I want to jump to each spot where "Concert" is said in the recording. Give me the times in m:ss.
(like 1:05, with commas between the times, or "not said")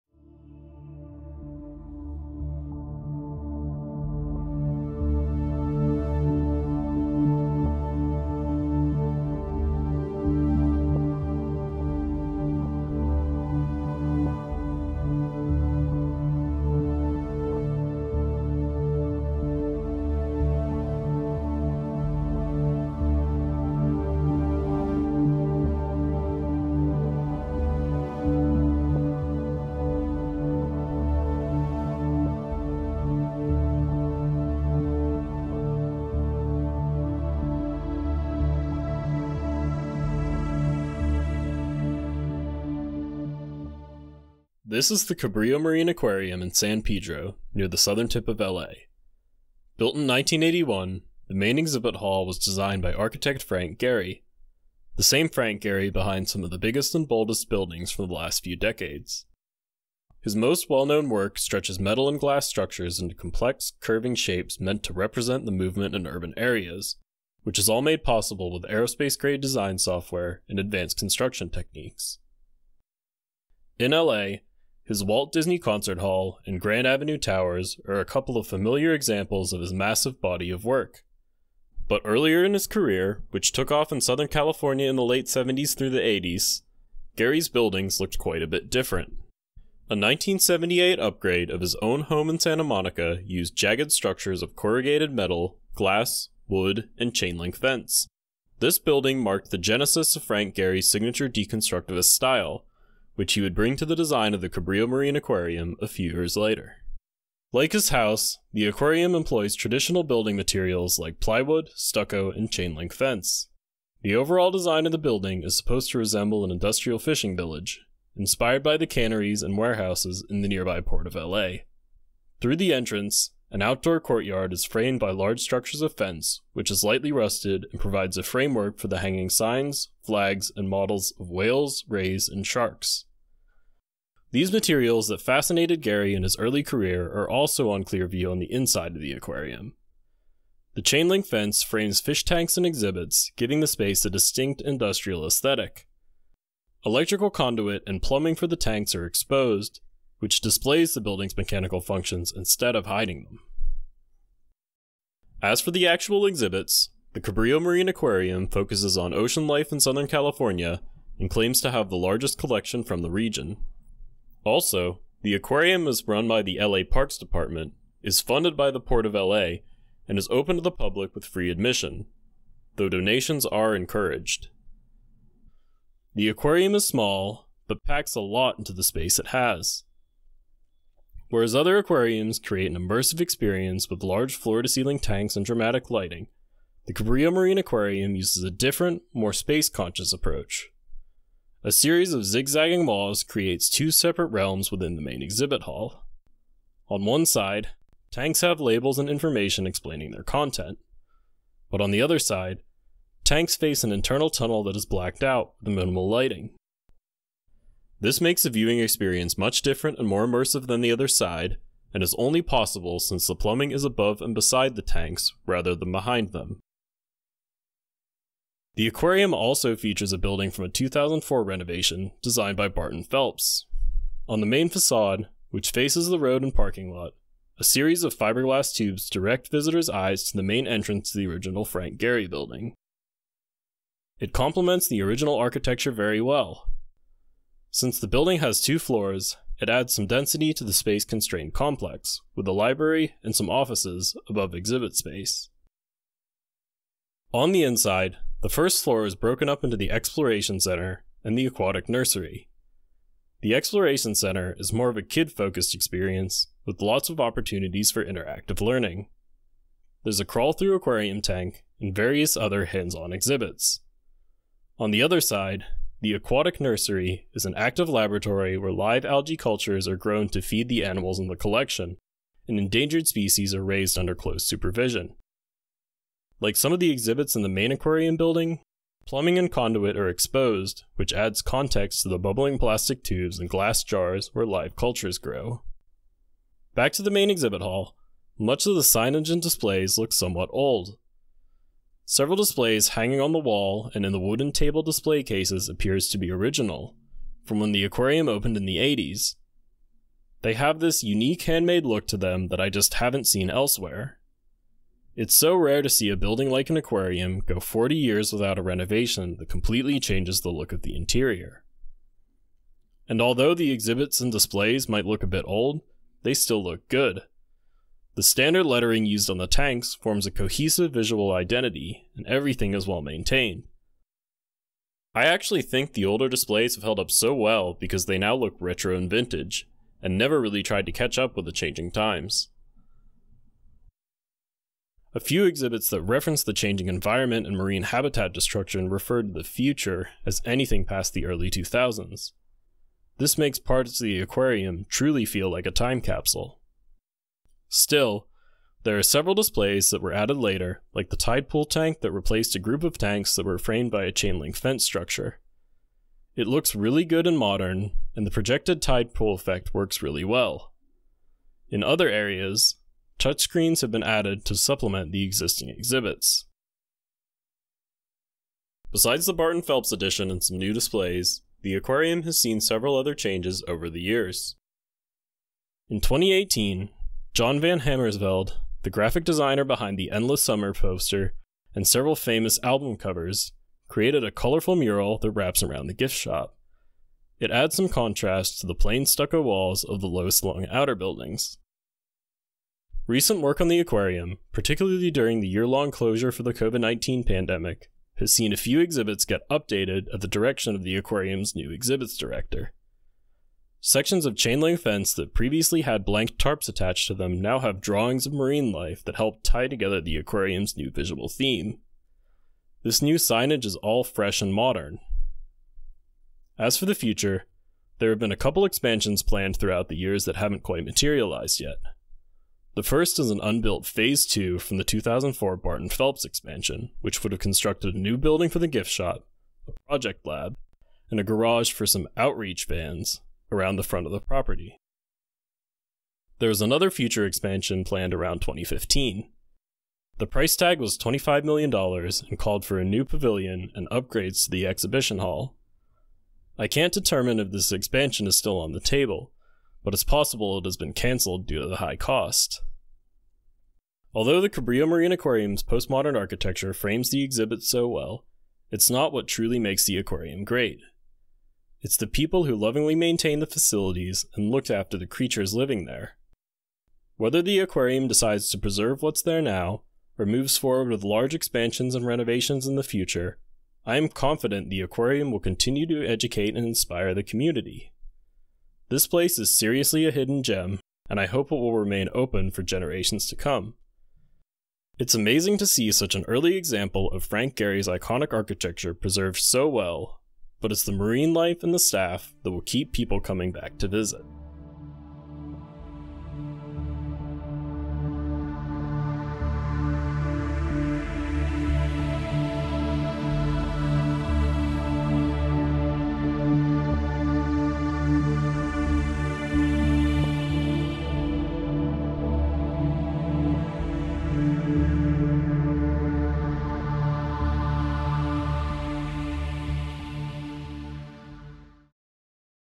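1:15.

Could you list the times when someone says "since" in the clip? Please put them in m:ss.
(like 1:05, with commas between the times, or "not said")
3:32, 3:57.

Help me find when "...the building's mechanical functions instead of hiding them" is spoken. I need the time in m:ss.
2:30.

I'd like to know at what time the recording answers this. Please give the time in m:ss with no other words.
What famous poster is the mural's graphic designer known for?
6:20.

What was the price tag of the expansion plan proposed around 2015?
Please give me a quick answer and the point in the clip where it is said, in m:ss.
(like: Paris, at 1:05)
$25 million, at 7:20.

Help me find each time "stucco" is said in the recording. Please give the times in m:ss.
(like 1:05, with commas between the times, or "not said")
1:51, 6:29.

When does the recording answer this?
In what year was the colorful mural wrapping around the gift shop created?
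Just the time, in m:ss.
6:16.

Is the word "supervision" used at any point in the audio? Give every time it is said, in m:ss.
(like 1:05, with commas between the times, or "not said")
4:34.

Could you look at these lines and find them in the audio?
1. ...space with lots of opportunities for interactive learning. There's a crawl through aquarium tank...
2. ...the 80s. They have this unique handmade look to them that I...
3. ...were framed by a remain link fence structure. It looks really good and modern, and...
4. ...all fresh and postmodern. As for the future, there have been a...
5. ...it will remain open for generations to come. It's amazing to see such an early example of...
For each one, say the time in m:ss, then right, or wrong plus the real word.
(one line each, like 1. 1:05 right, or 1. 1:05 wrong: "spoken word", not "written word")
1. 4:15 wrong: "experience", not "space"
2. 4:58 right
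3. 5:53 wrong: "chain", not "remain"
4. 6:53 wrong: "modern", not "postmodern"
5. 8:01 right.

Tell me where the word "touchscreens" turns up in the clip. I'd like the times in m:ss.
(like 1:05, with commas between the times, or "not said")
6:03.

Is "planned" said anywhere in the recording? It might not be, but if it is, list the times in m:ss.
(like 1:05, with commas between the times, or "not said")
6:59, 7:17.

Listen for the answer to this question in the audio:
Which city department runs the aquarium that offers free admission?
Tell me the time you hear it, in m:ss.
2:46.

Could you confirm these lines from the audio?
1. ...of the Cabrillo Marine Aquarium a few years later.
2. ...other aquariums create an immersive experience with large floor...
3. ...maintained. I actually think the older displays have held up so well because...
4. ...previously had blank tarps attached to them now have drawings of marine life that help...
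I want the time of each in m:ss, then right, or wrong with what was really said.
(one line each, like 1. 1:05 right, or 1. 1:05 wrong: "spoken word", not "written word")
1. 1:44 right
2. 3:01 right
3. 5:23 right
4. 6:45 right.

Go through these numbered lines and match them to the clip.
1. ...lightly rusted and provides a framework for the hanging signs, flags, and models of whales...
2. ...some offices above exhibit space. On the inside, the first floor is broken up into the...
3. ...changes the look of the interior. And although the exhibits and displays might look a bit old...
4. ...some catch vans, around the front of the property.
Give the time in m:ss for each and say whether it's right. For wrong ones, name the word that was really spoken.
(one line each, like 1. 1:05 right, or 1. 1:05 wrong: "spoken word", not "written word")
1. 2:06 right
2. 4:03 right
3. 5:10 right
4. 7:11 wrong: "outreach", not "catch".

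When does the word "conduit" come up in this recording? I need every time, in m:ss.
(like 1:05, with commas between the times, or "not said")
2:27, 4:39.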